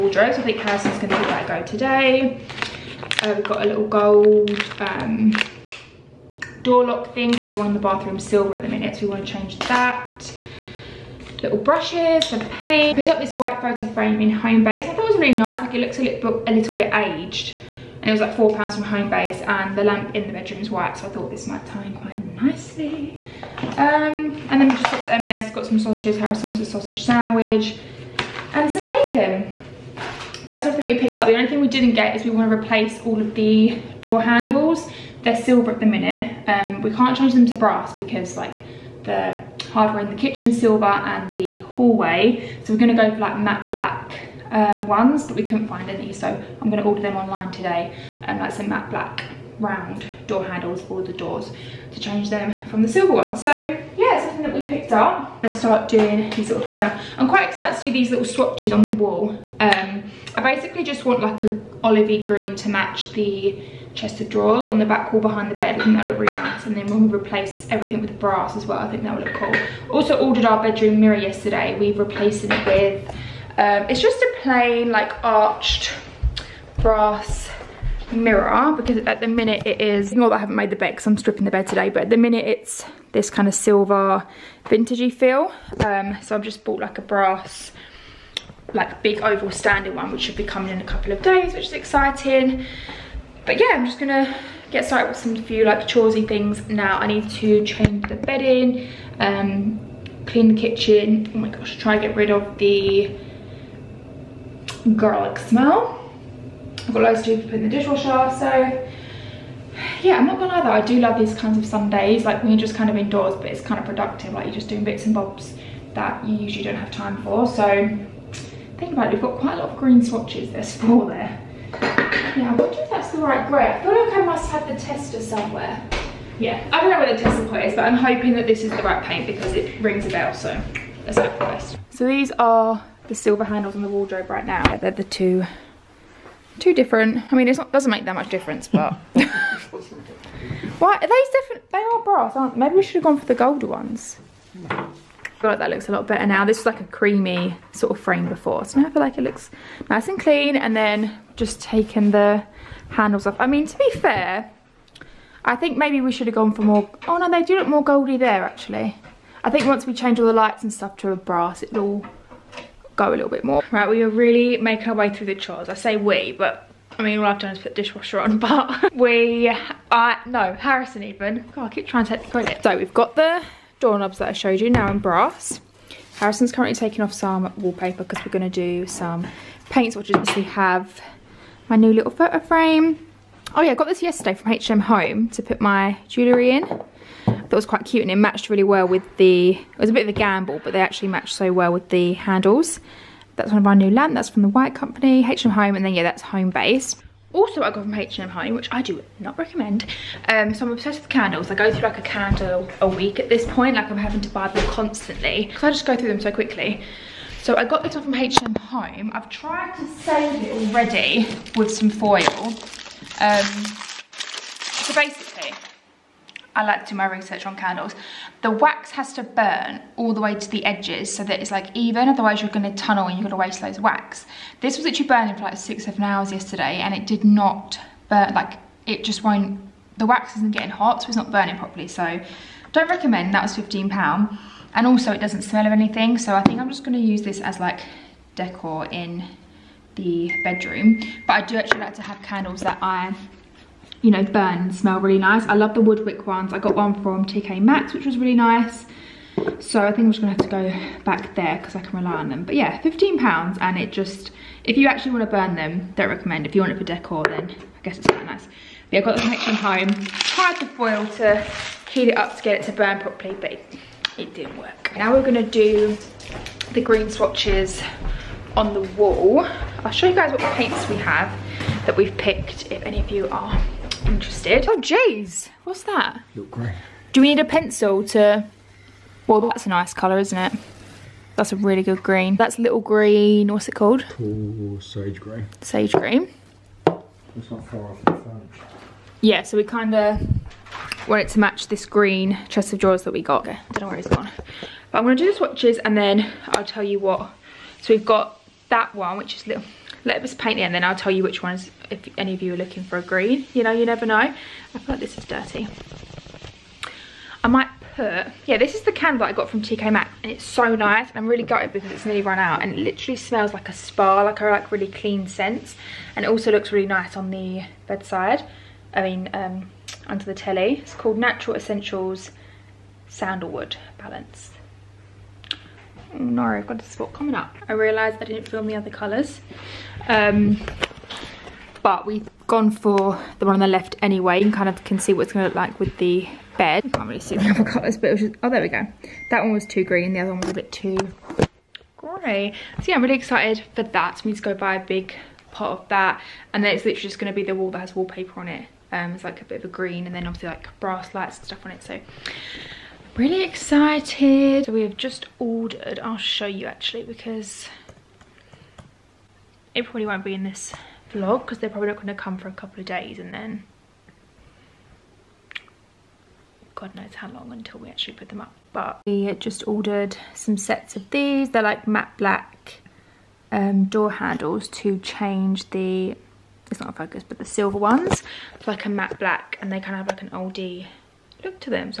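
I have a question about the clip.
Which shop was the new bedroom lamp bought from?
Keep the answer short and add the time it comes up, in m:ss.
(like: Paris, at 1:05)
The White Company, at 3:14.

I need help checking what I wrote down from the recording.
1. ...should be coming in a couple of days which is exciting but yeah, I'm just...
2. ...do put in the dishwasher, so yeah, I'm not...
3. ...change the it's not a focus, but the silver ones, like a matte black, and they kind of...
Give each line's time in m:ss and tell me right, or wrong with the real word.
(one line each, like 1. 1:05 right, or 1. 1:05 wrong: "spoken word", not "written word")
1. 1:30 right
2. 1:47 right
3. 6:14 right.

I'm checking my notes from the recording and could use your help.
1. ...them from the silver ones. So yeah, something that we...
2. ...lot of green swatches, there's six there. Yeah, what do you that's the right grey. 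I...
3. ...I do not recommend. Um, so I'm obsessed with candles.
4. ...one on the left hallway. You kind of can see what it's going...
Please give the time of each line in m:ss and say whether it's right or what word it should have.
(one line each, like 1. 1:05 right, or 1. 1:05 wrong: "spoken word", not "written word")
1. 0:52 right
2. 1:59 wrong: "four", not "six"
3. 3:18 right
4. 5:33 wrong: "anyway", not "hallway".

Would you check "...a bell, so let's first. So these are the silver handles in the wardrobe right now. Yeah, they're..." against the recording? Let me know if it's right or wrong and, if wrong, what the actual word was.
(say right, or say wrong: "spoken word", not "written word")
right.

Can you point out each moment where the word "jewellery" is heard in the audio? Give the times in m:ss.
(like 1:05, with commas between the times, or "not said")
3:06.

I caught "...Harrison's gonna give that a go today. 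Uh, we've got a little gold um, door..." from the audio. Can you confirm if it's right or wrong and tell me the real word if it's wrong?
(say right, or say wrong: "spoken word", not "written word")
right.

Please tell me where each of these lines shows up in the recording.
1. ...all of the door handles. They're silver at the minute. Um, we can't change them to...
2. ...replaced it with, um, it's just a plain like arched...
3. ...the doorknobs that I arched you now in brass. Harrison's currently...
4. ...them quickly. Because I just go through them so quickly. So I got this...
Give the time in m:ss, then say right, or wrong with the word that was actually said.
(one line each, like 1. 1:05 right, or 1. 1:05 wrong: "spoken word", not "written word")
1. 0:33 right
2. 1:11 right
3. 2:53 wrong: "showed", not "arched"
4. 3:24 wrong: "constantly", not "quickly".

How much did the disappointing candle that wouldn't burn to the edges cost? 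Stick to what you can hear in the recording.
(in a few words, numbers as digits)
15 pounds.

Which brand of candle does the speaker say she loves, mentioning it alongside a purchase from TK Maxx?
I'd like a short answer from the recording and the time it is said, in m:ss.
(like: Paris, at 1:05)
WoodWick, at 4:05.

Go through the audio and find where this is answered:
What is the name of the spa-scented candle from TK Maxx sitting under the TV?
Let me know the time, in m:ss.
5:21.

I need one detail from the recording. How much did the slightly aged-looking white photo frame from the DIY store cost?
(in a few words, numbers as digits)
4 pounds.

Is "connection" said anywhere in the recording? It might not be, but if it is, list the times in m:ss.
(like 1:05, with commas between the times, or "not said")
4:19.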